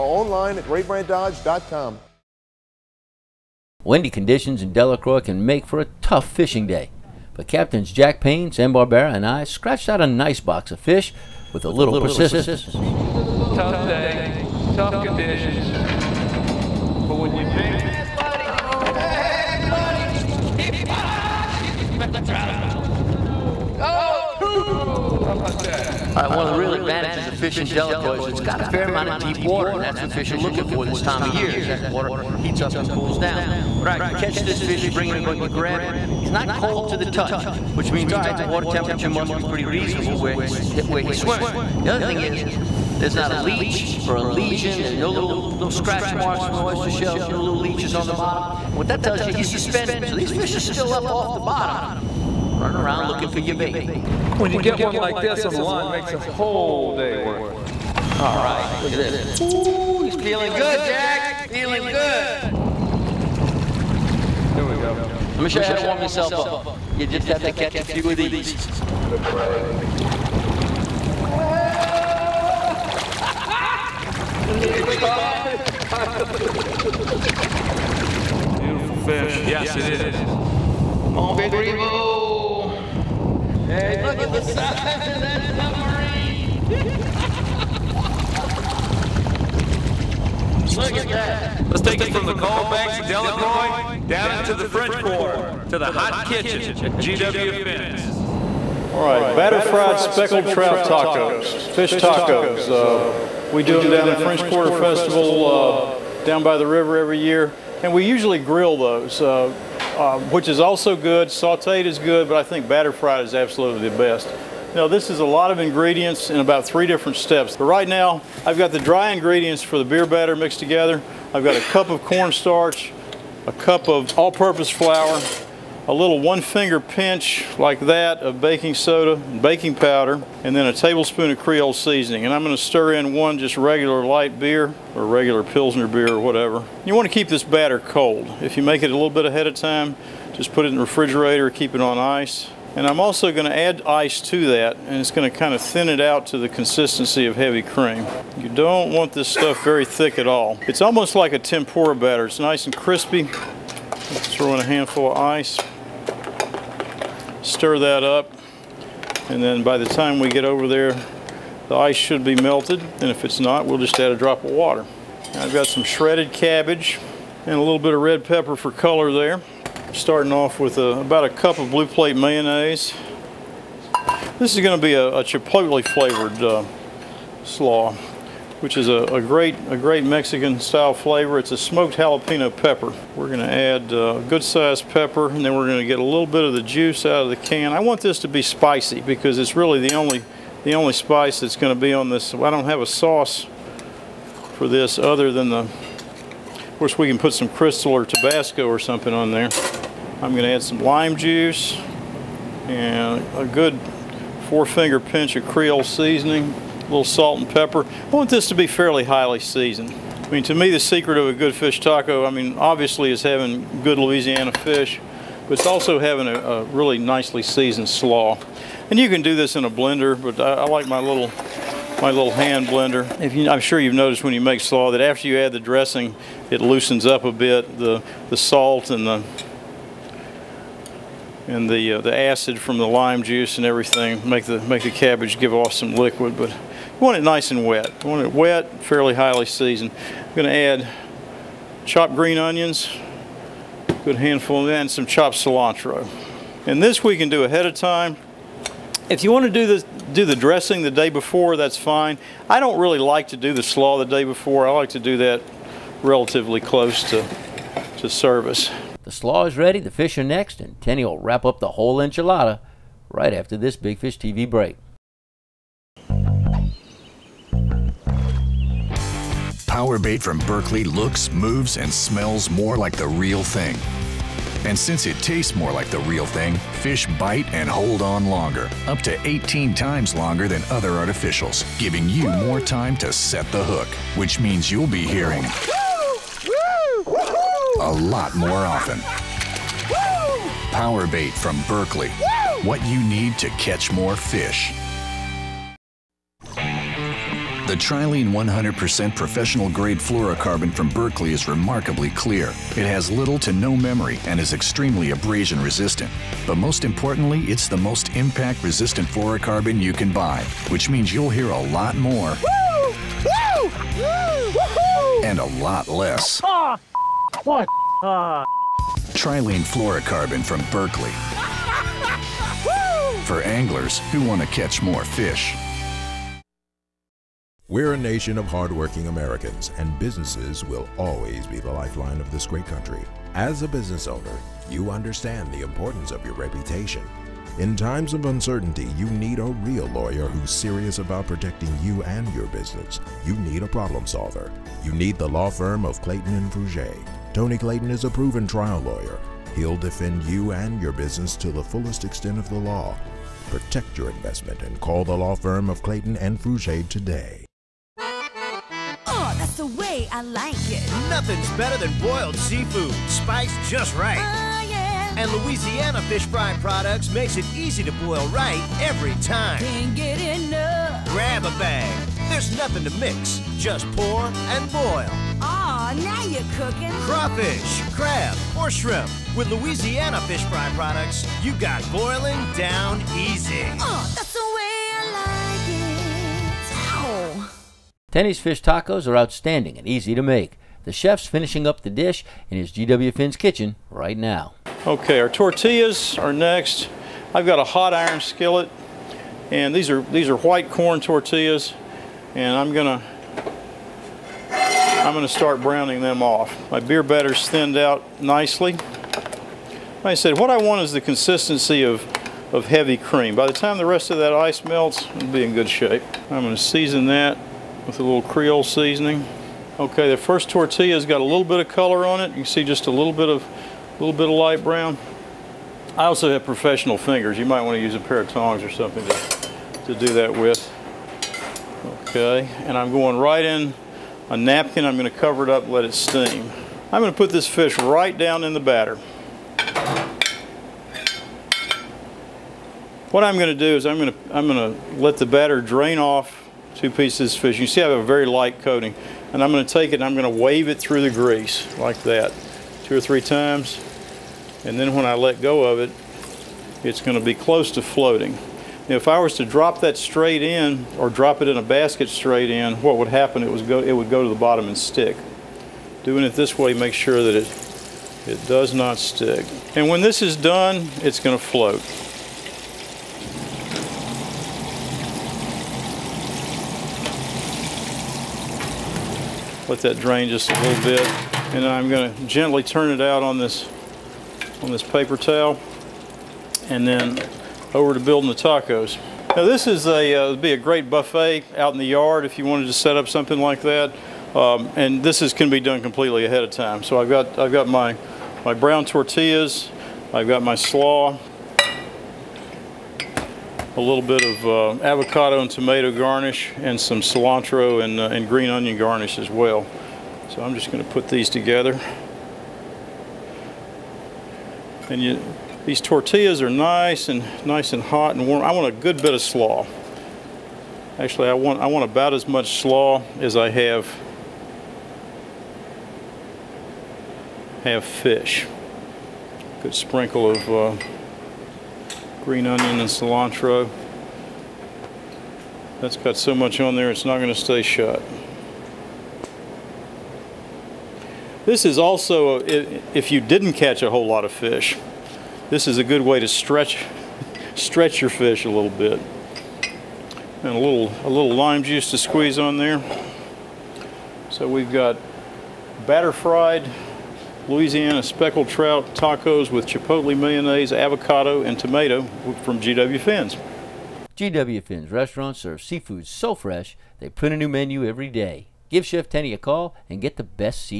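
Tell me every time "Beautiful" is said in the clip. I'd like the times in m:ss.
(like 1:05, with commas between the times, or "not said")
1:18.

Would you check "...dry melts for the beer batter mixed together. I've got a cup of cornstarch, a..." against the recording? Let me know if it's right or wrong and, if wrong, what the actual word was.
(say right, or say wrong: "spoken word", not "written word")
wrong: "ingredients", not "melts".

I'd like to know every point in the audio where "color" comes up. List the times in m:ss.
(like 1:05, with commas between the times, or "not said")
2:48, 7:01.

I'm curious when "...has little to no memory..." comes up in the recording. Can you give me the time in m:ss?
5:02.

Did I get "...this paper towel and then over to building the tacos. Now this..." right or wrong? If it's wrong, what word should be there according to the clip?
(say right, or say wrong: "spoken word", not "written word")
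right.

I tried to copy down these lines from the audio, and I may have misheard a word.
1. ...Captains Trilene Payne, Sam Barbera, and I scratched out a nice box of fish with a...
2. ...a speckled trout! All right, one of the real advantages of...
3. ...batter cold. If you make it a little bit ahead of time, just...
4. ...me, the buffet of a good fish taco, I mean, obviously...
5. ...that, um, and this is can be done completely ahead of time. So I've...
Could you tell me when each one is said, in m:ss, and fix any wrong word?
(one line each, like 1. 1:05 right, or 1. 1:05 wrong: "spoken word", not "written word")
1. 0:07 wrong: "Jack", not "Trilene"
2. 0:21 right
3. 2:17 right
4. 3:30 wrong: "secret", not "buffet"
5. 8:13 right.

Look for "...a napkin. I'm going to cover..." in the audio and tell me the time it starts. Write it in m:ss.
7:14.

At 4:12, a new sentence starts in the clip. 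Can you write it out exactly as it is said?
I don't really like to do the slaw the day before.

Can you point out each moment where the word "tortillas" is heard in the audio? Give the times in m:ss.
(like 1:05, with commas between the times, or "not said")
6:35, 6:40, 7:00, 8:18, 8:35.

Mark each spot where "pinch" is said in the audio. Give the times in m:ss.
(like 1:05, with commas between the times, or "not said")
2:06, 3:24.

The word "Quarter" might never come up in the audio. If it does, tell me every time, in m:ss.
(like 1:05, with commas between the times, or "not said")
1:34, 1:44.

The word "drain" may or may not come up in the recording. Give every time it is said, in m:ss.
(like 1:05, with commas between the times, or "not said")
7:25, 7:59.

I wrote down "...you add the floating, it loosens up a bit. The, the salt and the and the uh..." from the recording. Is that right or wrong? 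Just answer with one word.
wrong.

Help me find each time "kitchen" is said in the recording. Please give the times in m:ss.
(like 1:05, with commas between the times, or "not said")
1:36, 6:33.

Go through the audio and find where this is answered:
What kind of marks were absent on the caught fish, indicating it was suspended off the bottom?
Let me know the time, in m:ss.
0:45.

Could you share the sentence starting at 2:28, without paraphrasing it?
You don't want this stuff very thick at all.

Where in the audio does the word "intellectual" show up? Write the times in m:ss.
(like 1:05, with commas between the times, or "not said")
not said.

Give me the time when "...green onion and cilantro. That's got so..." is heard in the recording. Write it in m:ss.
8:52.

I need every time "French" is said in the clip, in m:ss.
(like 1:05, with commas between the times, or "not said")
1:34, 1:44.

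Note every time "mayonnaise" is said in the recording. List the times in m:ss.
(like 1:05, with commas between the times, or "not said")
2:52, 9:20.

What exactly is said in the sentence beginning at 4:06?
And this we can do ahead of time.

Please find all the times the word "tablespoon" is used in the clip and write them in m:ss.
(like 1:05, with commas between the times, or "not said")
2:10.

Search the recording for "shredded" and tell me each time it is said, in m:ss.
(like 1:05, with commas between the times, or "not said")
2:45.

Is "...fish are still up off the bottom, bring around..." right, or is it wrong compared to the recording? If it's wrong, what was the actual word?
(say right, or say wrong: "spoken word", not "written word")
wrong: "running", not "bring".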